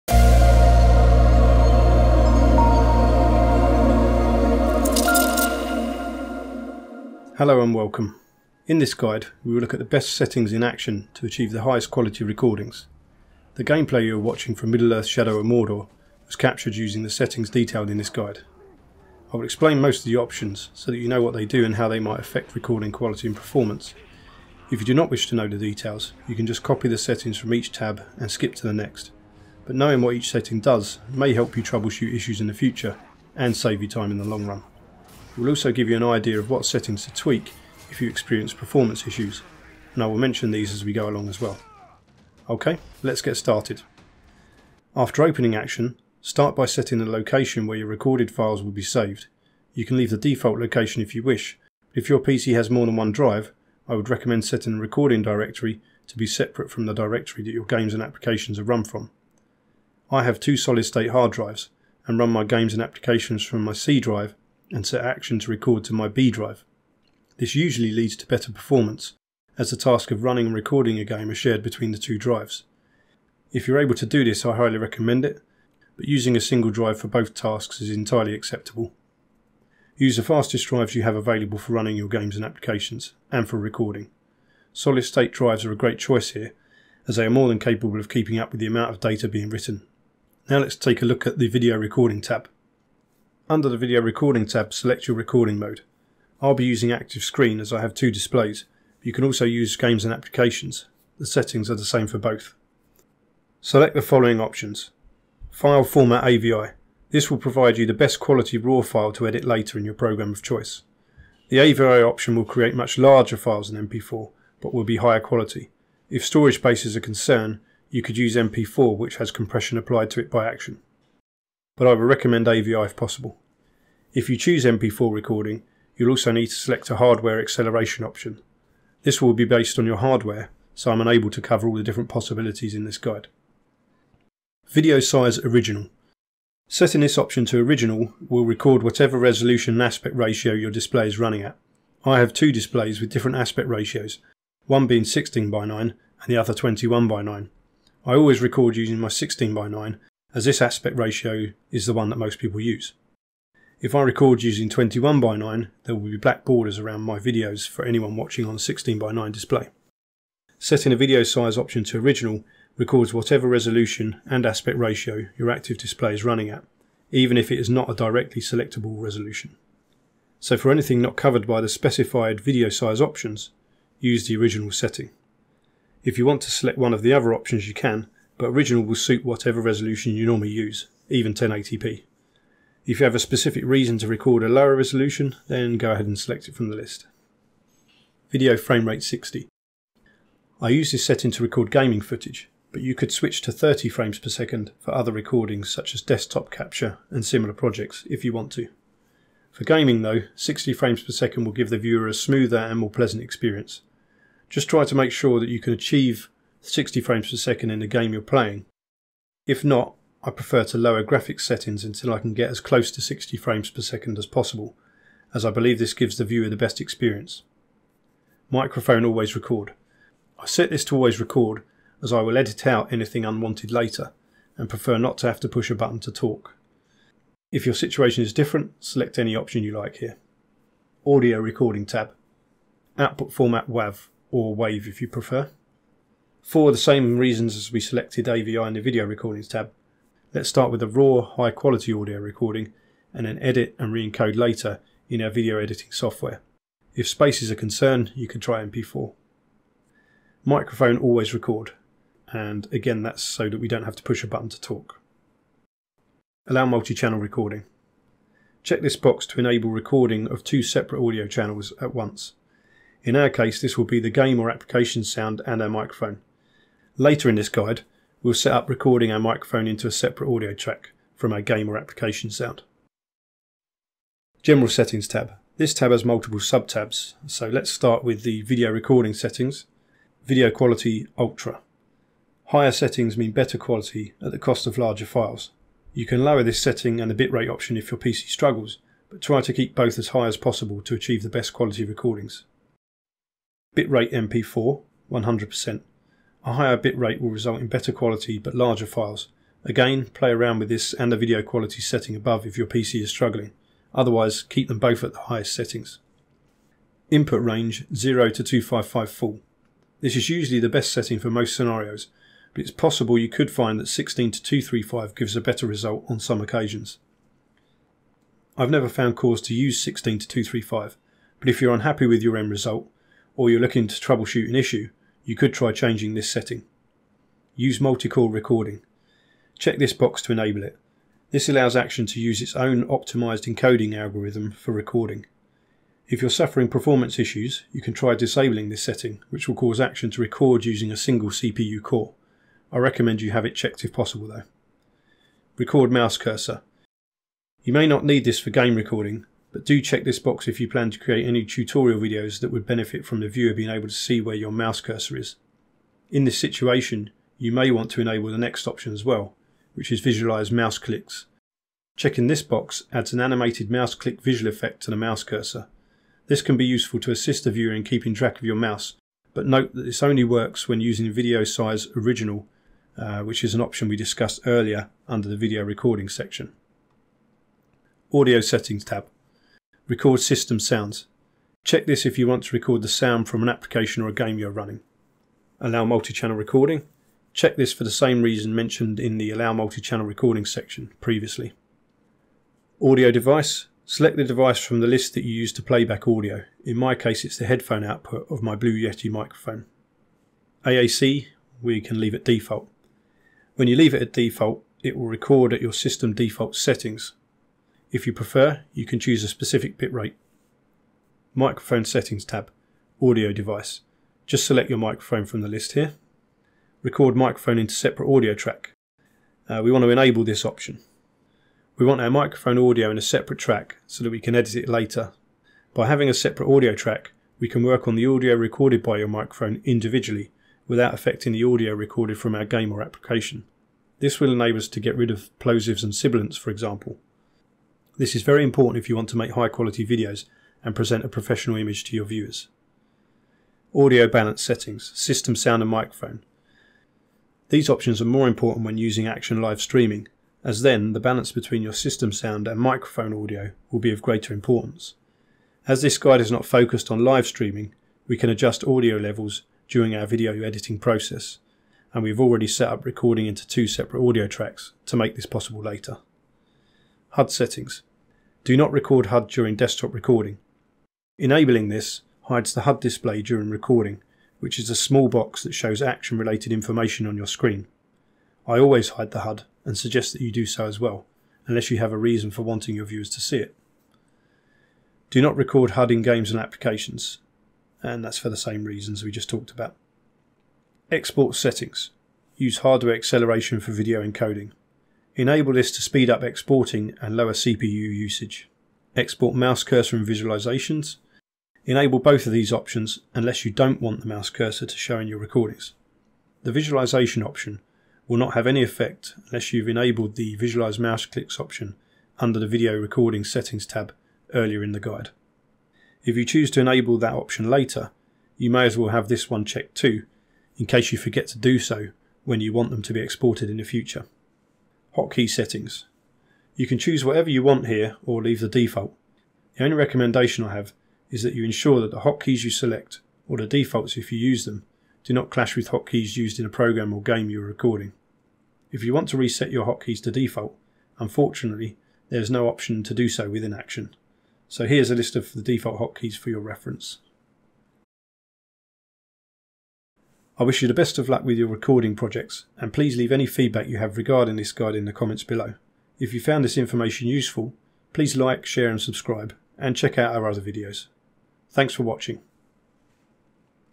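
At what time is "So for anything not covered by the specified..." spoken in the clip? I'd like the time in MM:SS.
02:50.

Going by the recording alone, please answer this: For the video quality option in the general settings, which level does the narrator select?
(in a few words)
Ultra.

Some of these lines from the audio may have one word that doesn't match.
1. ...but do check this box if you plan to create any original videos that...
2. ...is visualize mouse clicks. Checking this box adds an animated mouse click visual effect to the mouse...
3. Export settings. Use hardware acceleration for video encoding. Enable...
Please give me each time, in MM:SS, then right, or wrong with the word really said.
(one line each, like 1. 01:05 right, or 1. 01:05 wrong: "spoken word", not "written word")
1. 05:49 wrong: "tutorial", not "original"
2. 05:59 right
3. 08:10 right.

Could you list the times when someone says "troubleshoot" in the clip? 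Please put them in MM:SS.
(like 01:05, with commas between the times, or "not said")
00:31, 05:23.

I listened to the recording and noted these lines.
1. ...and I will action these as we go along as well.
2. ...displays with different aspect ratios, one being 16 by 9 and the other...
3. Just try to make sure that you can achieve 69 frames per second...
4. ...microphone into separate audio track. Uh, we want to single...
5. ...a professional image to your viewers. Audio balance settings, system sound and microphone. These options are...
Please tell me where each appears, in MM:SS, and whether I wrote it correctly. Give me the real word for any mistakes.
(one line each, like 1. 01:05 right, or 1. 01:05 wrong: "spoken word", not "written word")
1. 00:39 wrong: "mention", not "action"
2. 02:22 right
3. 03:24 wrong: "60", not "69"
4. 06:57 wrong: "enable", not "single"
5. 07:21 right.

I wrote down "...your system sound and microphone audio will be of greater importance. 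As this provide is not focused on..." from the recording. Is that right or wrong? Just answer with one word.
wrong.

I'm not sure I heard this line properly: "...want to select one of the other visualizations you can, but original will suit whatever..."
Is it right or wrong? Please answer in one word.
wrong.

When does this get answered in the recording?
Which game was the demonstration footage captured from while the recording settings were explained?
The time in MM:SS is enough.
00:14.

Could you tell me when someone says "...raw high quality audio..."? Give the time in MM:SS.
04:00.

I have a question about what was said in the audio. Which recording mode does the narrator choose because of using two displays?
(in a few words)
Active screen.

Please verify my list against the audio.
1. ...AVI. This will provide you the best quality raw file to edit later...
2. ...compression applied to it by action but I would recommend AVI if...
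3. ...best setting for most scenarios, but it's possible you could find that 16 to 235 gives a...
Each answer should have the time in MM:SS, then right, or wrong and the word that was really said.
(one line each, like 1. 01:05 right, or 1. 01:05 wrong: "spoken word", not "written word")
1. 01:46 right
2. 01:59 right
3. 05:10 right.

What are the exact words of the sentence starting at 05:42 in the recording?
I recommend you have it checked if possible though.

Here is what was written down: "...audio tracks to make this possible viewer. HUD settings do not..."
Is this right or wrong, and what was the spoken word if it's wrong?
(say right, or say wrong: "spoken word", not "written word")
wrong: "later", not "viewer".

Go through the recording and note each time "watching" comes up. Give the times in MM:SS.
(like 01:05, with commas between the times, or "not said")
00:14, 02:38, 09:21.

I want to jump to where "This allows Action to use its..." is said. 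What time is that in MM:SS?
05:31.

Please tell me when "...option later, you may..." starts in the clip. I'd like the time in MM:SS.
08:37.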